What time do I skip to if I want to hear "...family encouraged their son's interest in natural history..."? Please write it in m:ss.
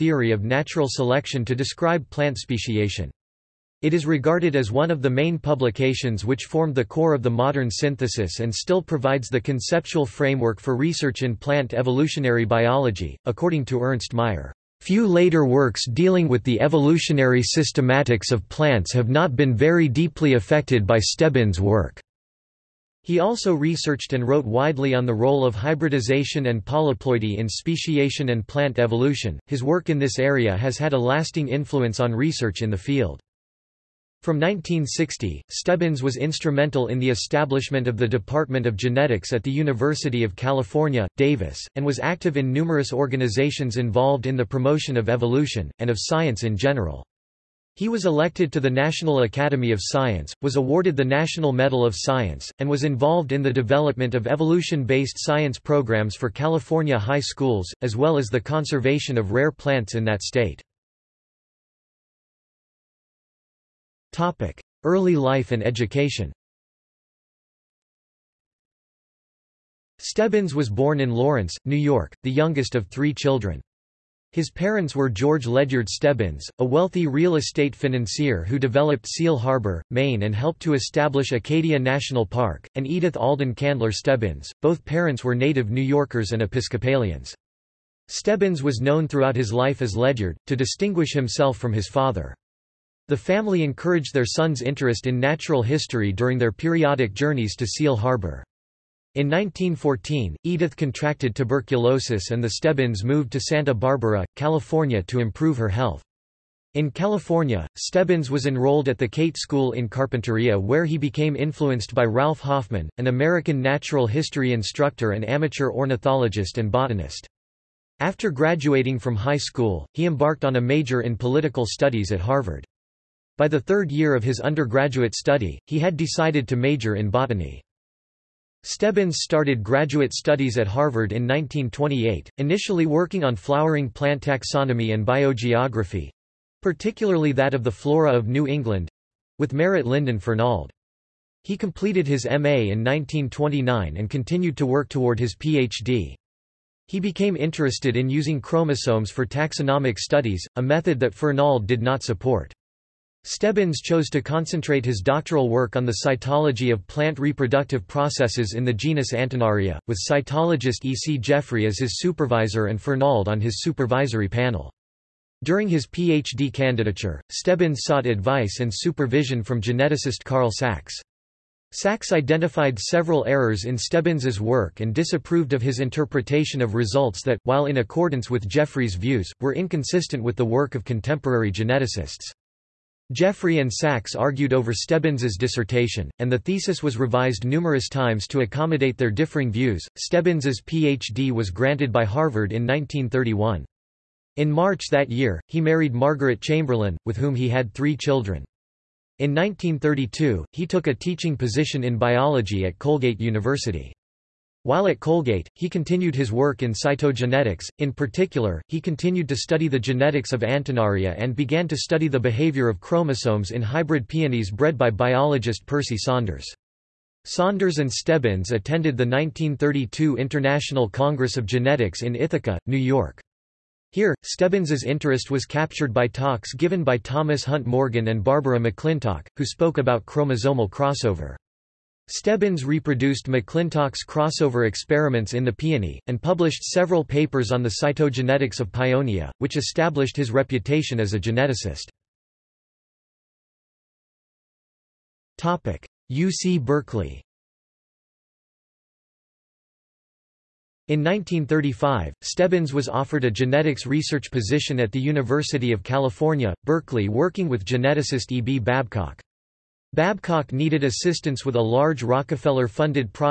1:33.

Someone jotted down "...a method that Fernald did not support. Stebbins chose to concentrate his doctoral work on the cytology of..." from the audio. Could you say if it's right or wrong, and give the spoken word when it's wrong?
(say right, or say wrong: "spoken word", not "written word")
right.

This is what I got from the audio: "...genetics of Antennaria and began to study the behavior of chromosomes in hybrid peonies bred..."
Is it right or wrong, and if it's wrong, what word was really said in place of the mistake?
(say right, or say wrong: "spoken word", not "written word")
right.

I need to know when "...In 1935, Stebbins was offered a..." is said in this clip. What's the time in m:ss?
4:10.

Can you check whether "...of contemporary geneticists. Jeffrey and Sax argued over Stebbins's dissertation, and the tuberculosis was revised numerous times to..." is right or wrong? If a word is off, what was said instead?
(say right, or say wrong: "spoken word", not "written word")
wrong: "thesis", not "tuberculosis".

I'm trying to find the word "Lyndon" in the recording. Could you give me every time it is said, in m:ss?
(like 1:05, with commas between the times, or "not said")
2:19.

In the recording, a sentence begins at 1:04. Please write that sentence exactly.
Early life and education Stebbins was born in Lawrence, New York, the youngest of three children.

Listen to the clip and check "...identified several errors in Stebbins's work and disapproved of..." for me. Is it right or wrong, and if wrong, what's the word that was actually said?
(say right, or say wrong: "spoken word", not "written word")
right.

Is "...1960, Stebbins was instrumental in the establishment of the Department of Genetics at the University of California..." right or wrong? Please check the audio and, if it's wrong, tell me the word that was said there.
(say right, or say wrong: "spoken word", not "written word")
right.